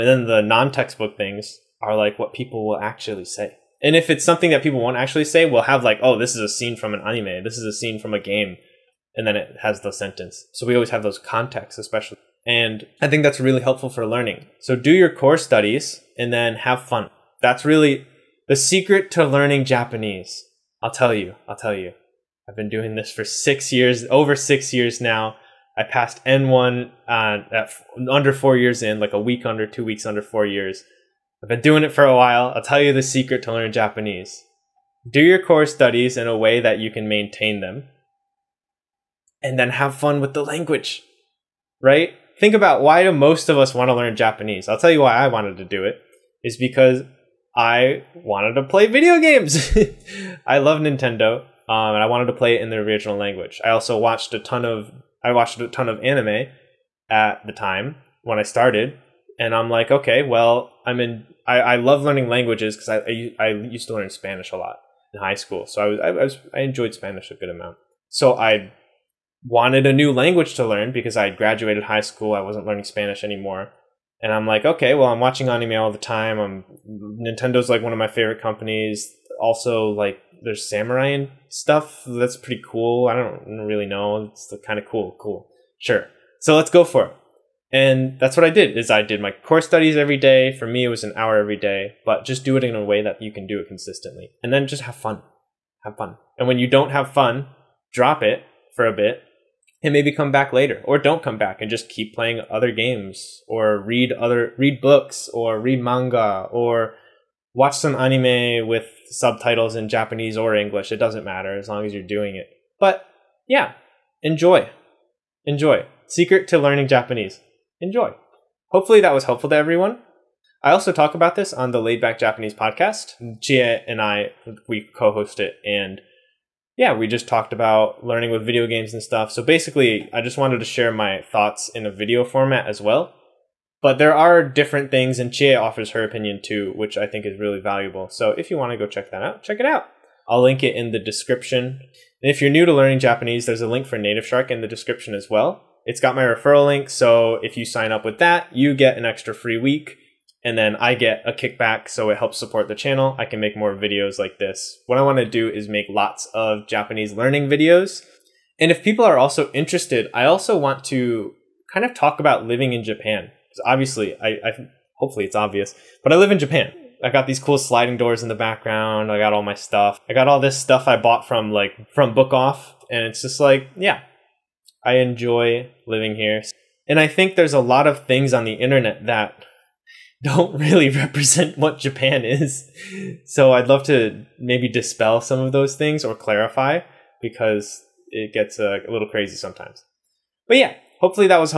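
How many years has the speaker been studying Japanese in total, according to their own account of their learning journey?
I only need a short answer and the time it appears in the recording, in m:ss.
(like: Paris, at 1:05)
over 6 years, at 0:24.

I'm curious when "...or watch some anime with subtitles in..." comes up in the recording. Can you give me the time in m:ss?
1:46.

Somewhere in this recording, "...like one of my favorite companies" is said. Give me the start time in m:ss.
1:17.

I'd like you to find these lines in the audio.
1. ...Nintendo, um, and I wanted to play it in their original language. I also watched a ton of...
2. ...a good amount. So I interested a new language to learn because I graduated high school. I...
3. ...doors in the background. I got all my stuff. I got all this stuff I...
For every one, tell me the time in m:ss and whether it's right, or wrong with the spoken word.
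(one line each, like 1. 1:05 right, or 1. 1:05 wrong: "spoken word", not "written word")
1. 0:50 right
2. 1:07 wrong: "wanted", not "interested"
3. 2:47 right.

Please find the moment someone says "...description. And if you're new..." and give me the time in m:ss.
2:20.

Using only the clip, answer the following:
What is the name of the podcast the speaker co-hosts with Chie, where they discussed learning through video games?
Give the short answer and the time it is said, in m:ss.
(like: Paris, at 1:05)
Laid Back Japanese, at 2:01.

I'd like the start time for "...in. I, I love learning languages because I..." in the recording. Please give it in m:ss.
1:00.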